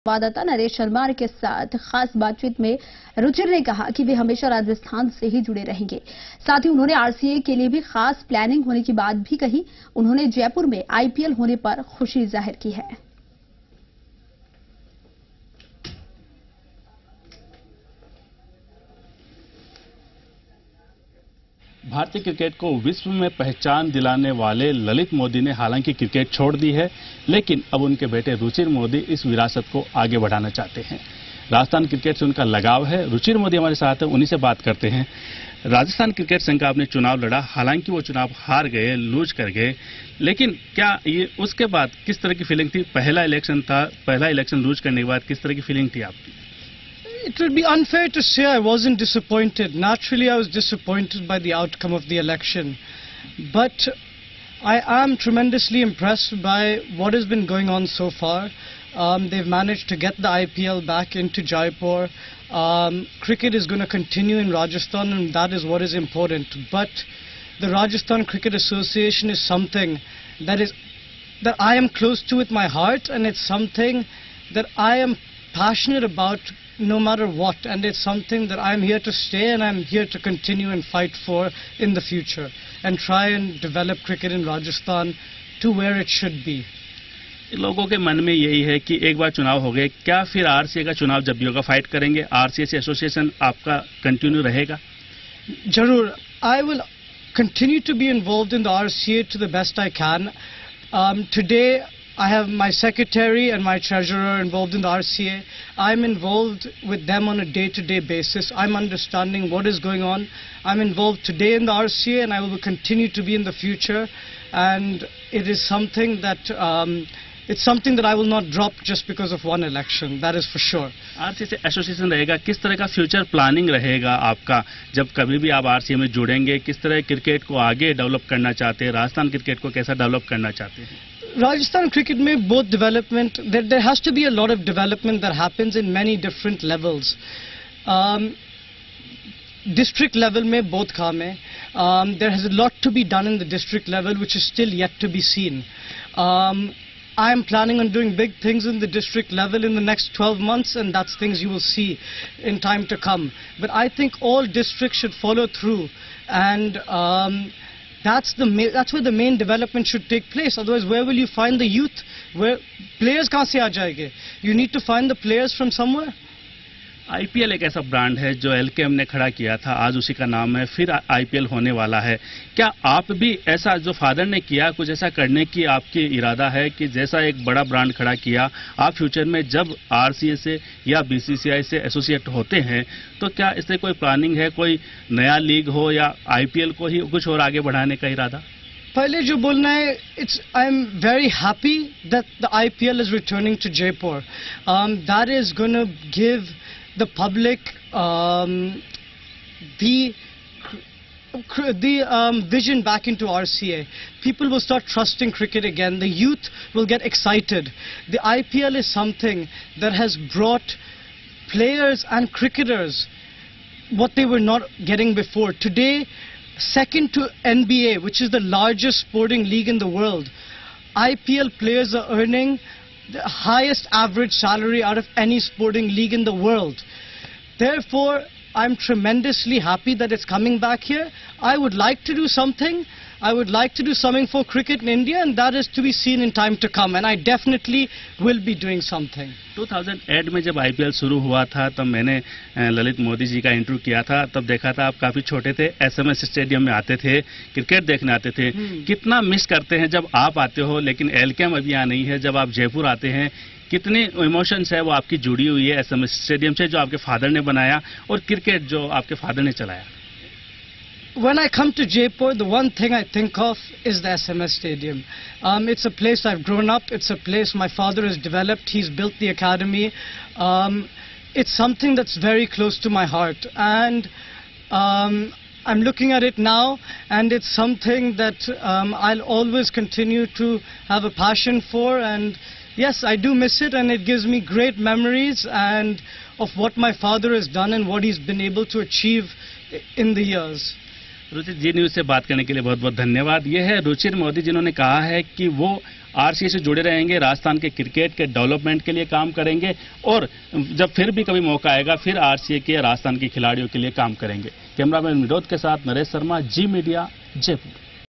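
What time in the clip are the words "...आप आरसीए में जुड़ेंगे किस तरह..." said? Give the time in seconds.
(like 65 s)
125 s.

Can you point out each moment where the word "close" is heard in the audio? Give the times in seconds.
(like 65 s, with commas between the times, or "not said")
71 s, 272 s.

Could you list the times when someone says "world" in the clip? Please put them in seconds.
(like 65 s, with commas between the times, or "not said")
219 s, 226 s.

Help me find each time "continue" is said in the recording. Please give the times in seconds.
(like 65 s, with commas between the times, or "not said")
63 s, 80 s, 112 s, 279 s.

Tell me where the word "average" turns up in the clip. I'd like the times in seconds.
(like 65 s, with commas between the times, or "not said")
223 s.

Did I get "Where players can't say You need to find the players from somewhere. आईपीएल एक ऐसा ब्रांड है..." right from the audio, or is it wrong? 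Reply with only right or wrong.
right.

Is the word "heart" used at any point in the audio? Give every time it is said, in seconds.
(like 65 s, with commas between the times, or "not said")
72 s, 273 s.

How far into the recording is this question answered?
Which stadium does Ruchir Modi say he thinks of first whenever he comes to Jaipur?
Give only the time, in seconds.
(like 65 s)
264 s.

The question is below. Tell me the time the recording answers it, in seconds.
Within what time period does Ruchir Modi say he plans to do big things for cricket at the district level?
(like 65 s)
150 s.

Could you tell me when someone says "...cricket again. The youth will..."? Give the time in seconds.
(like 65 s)
205 s.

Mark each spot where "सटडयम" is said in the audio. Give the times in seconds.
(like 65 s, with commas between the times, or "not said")
246 s, 256 s.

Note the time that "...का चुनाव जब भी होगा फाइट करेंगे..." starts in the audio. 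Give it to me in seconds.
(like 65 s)
90 s.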